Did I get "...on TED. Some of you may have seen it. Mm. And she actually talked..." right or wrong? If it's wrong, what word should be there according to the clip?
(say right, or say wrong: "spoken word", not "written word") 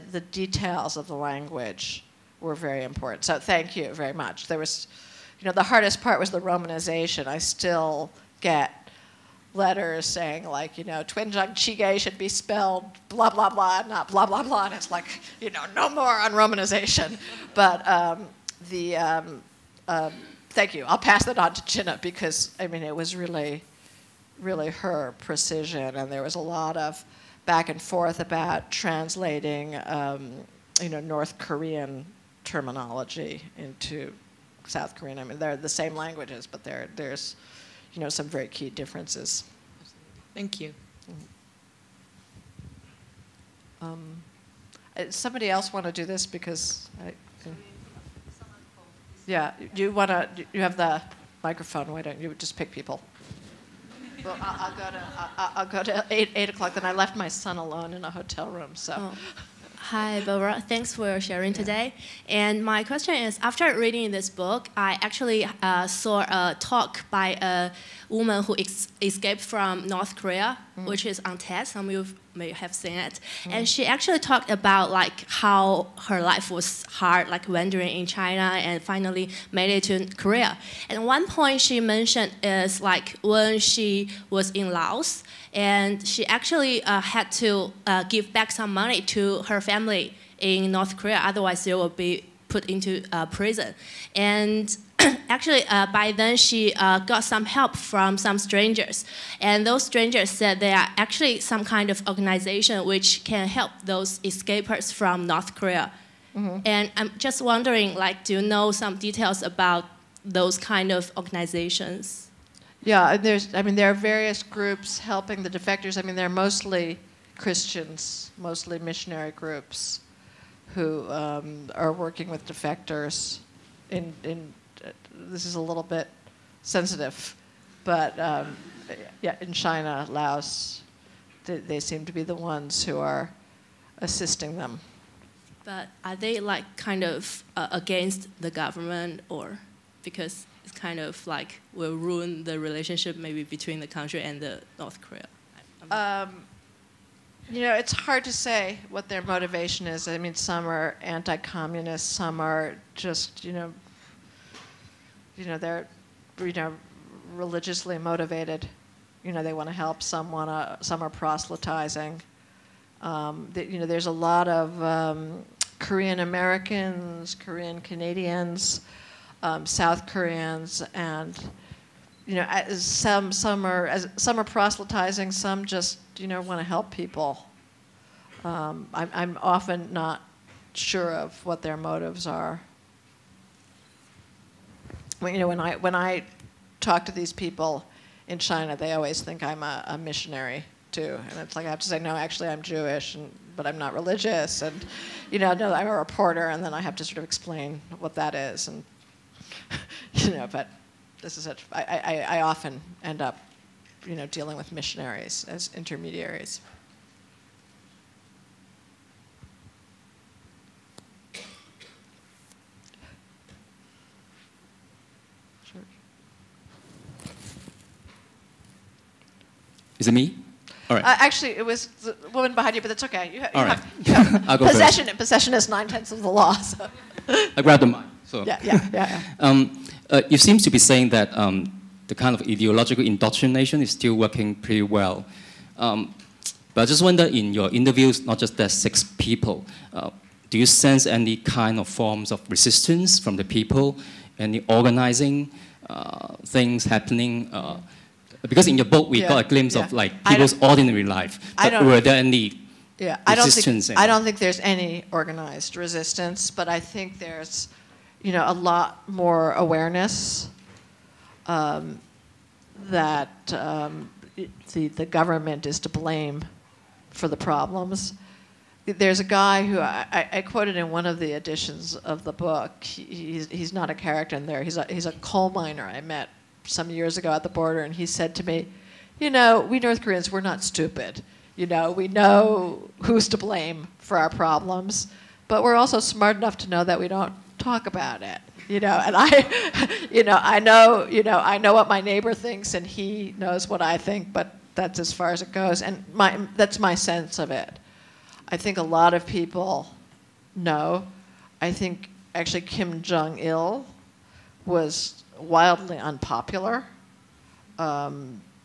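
right.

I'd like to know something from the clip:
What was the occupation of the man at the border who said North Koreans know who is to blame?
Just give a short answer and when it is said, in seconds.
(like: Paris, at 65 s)
Coal miner, at 275 s.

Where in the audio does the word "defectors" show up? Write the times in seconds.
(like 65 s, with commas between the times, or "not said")
115 s, 122 s.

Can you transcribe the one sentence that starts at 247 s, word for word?
Uh, because in your book, we yeah, got a glimpse yeah.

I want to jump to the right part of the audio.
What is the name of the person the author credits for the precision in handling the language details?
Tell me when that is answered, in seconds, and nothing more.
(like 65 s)
21 s.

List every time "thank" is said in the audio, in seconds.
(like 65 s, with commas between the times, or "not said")
3 s, 20 s, 40 s, 60 s.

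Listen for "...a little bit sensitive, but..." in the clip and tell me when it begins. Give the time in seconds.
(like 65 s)
125 s.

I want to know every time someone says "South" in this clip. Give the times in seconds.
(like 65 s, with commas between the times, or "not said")
34 s, 169 s.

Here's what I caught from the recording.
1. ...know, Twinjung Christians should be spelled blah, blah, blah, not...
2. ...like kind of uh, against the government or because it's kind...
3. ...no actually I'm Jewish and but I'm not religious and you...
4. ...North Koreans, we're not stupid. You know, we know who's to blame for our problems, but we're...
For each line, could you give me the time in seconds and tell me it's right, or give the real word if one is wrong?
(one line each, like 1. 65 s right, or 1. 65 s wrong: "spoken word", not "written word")
1. 10 s wrong: "Chige", not "Christians"
2. 136 s right
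3. 191 s right
4. 279 s right.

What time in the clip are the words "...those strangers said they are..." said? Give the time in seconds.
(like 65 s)
99 s.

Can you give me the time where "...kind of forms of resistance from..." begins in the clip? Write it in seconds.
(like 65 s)
241 s.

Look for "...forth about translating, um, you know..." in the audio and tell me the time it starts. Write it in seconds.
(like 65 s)
27 s.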